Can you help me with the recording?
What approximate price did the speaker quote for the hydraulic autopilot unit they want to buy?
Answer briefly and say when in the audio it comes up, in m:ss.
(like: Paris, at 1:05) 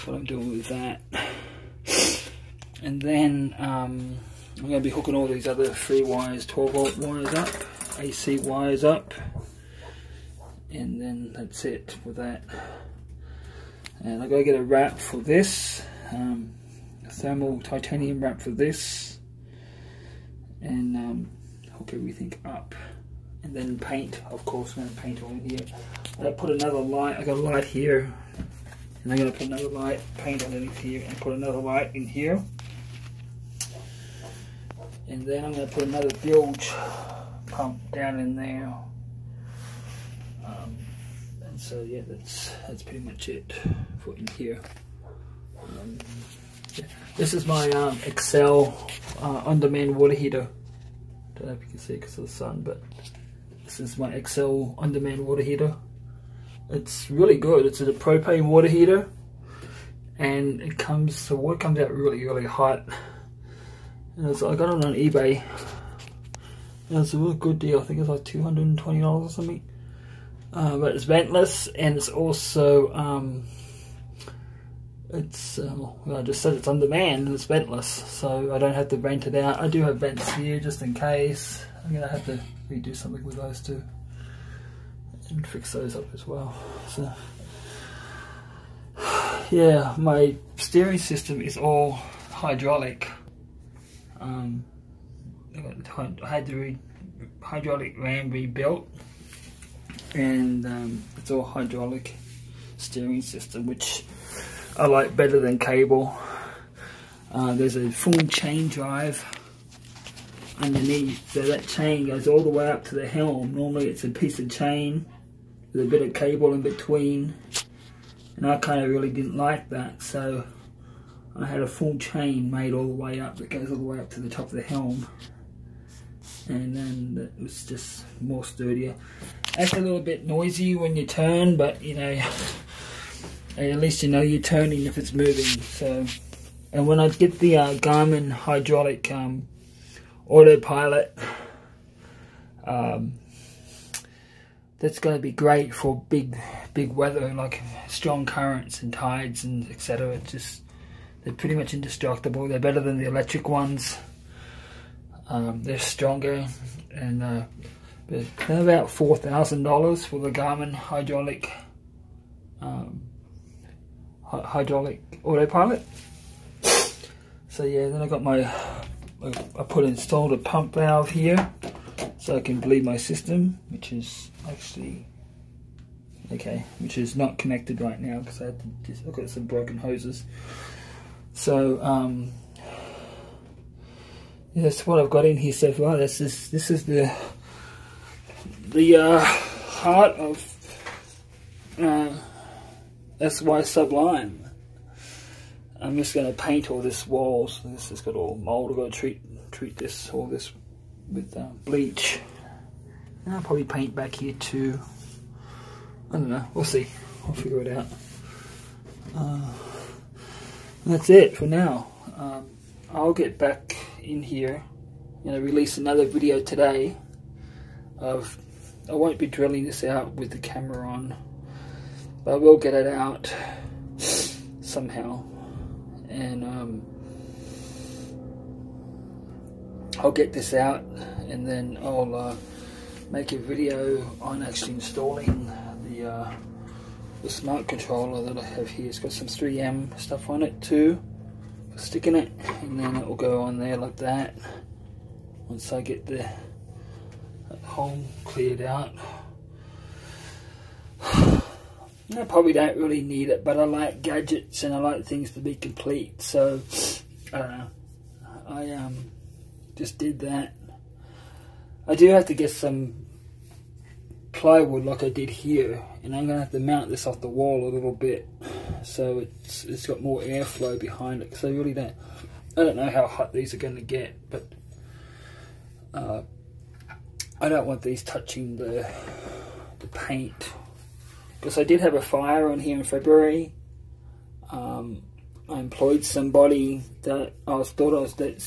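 $4,000, at 2:38.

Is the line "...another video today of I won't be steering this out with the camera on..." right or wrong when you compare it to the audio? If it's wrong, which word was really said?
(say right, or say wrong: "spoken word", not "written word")
wrong: "drilling", not "steering".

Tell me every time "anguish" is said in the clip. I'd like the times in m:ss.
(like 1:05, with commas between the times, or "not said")
not said.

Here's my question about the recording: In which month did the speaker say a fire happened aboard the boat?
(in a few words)
February.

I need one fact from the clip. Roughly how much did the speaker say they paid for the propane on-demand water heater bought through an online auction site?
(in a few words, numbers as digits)
$220.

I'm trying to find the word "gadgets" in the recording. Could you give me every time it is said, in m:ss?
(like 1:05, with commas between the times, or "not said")
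4:14.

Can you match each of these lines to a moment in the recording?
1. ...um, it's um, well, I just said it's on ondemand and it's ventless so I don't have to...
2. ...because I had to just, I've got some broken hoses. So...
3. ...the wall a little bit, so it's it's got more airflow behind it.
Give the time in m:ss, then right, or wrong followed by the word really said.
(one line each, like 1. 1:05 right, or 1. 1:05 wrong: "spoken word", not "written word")
1. 1:12 wrong: "demand", not "ondemand"
2. 2:58 right
3. 4:27 right.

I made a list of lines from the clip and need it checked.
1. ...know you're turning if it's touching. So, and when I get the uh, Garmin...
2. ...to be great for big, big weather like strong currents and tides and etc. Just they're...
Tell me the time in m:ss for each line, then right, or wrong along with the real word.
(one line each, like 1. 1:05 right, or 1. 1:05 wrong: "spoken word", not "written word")
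1. 2:14 wrong: "moving", not "touching"
2. 2:25 right.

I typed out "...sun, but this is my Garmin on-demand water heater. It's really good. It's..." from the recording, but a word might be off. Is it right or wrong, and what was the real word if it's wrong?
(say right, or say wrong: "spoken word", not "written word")
wrong: "Excel", not "Garmin".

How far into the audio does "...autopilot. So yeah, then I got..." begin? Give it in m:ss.
2:45.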